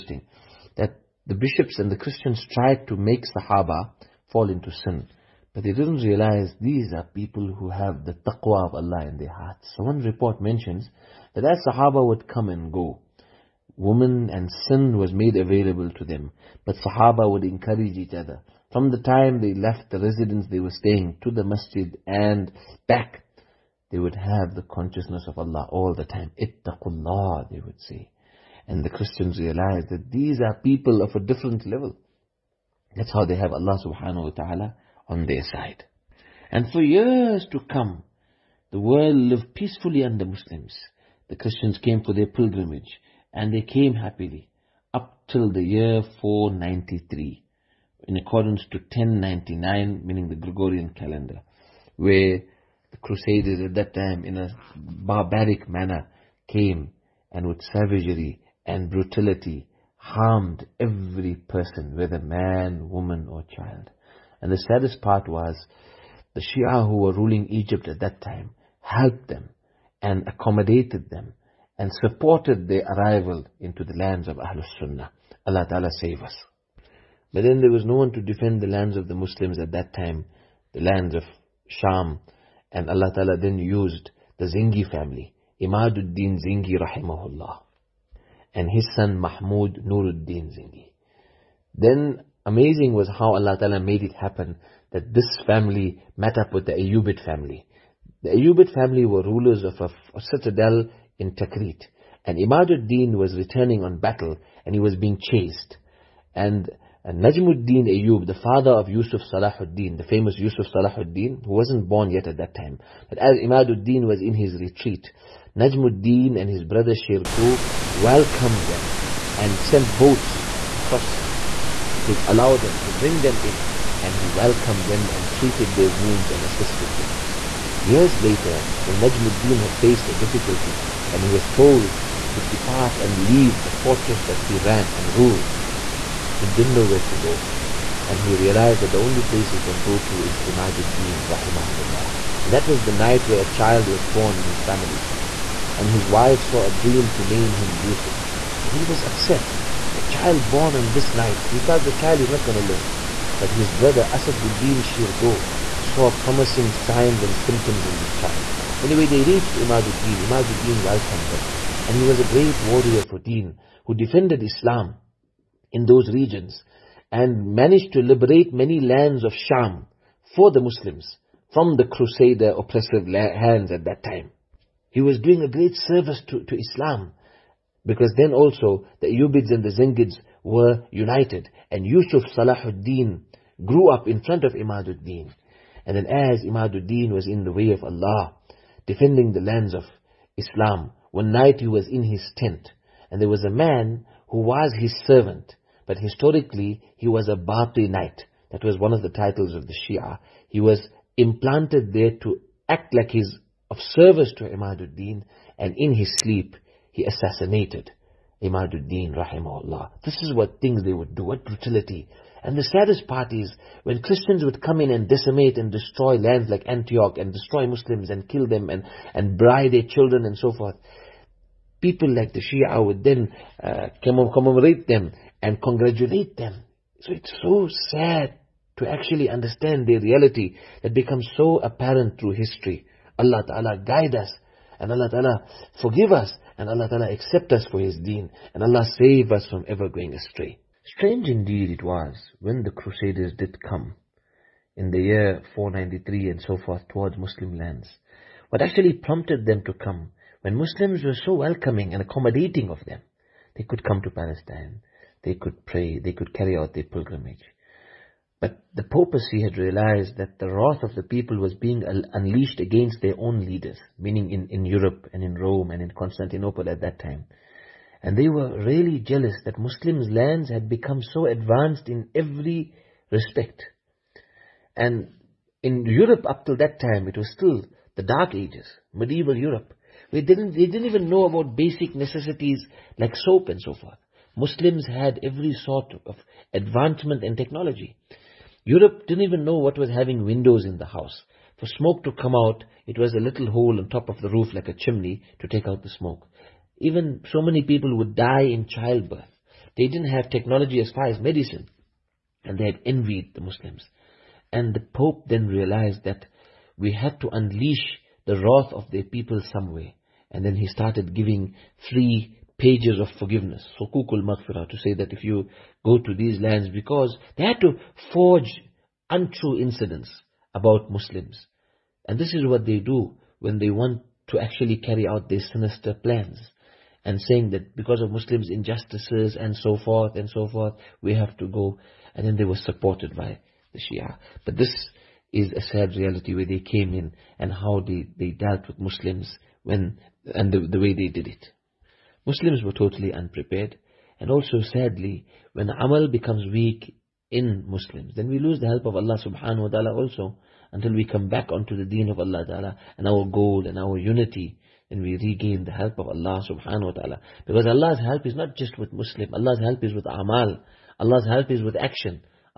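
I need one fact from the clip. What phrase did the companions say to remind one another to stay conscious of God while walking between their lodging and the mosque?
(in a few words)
Ittaqullah.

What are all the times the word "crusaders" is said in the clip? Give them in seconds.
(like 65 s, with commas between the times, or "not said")
53 s, 171 s, 242 s.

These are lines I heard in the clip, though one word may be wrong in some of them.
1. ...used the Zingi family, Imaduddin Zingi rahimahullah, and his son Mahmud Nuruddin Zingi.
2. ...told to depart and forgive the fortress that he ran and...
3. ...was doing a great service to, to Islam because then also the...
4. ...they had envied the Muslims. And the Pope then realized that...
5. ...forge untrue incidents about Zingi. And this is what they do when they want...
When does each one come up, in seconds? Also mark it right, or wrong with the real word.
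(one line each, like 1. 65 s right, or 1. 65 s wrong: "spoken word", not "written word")
1. 83 s right
2. 131 s wrong: "leave", not "forgive"
3. 175 s right
4. 302 s right
5. 318 s wrong: "Muslims", not "Zingi".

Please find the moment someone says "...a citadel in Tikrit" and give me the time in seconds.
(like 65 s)
100 s.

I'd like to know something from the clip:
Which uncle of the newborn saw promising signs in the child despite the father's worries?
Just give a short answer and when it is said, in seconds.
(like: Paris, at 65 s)
Asaduddin Shirkuh, at 154 s.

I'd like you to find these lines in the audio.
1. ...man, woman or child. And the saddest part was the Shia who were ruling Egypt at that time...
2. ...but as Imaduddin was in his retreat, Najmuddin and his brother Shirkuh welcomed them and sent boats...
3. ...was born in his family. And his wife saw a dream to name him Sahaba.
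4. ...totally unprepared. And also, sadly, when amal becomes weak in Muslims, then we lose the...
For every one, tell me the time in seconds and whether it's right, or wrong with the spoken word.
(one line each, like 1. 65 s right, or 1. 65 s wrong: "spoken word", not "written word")
1. 62 s right
2. 113 s right
3. 143 s wrong: "Yusuf", not "Sahaba"
4. 342 s right.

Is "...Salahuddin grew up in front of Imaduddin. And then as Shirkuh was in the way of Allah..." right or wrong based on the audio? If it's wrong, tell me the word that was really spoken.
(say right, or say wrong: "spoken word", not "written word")
wrong: "Imaduddin", not "Shirkuh".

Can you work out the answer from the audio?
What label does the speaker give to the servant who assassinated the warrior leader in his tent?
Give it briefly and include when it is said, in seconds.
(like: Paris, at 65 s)
Batini, at 197 s.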